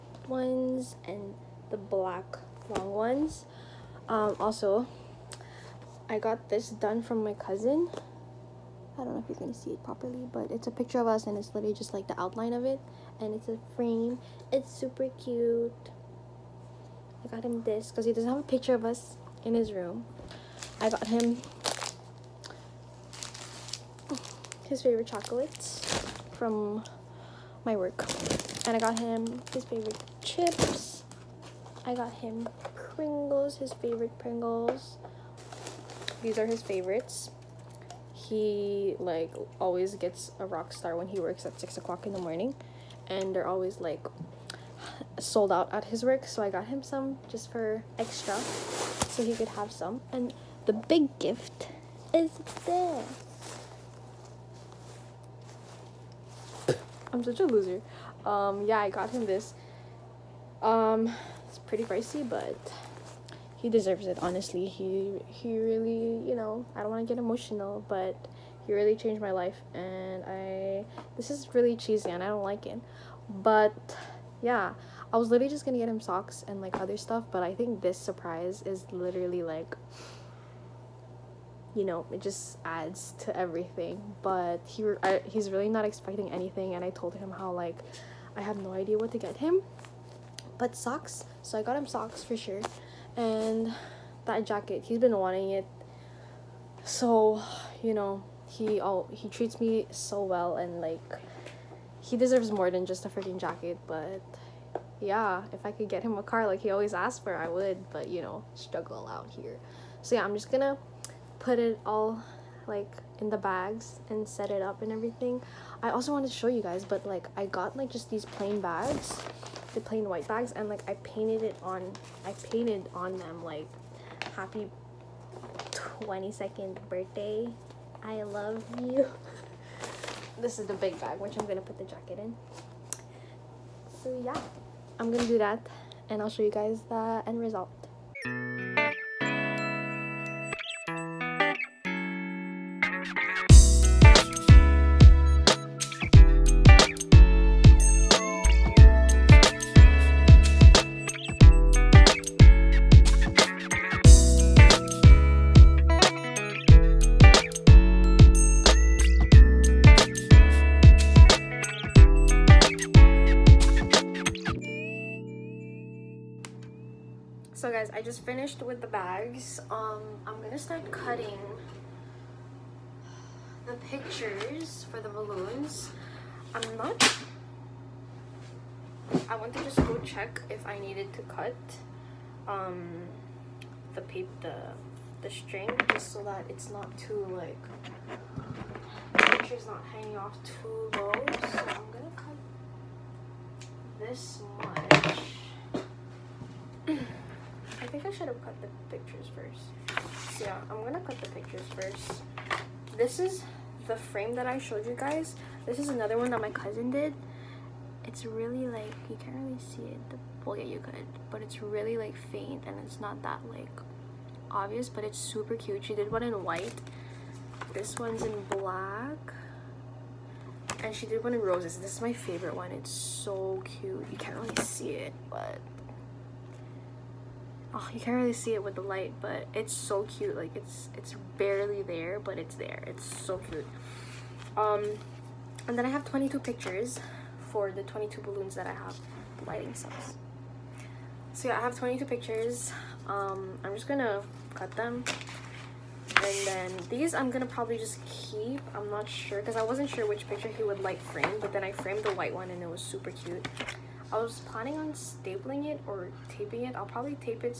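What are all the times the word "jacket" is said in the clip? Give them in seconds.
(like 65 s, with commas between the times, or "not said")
94 s, 103 s, 131 s.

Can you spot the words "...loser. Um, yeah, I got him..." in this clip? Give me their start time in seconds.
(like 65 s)
57 s.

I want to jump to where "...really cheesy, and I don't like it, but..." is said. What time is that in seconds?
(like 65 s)
71 s.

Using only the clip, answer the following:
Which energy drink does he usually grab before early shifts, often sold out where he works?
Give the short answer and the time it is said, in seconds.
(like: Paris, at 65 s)
Rockstar, at 40 s.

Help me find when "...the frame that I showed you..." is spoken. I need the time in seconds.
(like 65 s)
203 s.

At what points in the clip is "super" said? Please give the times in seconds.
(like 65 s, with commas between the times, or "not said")
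14 s, 215 s, 252 s.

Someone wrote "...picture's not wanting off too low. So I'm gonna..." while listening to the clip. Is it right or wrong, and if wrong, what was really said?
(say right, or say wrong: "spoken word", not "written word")
wrong: "hanging", not "wanting".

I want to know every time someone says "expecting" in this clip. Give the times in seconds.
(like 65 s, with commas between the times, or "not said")
85 s.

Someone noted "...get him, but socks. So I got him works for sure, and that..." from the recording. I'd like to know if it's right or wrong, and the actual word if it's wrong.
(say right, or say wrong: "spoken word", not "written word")
wrong: "socks", not "works".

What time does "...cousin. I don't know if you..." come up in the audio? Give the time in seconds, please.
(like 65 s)
7 s.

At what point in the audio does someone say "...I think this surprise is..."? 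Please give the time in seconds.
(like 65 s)
77 s.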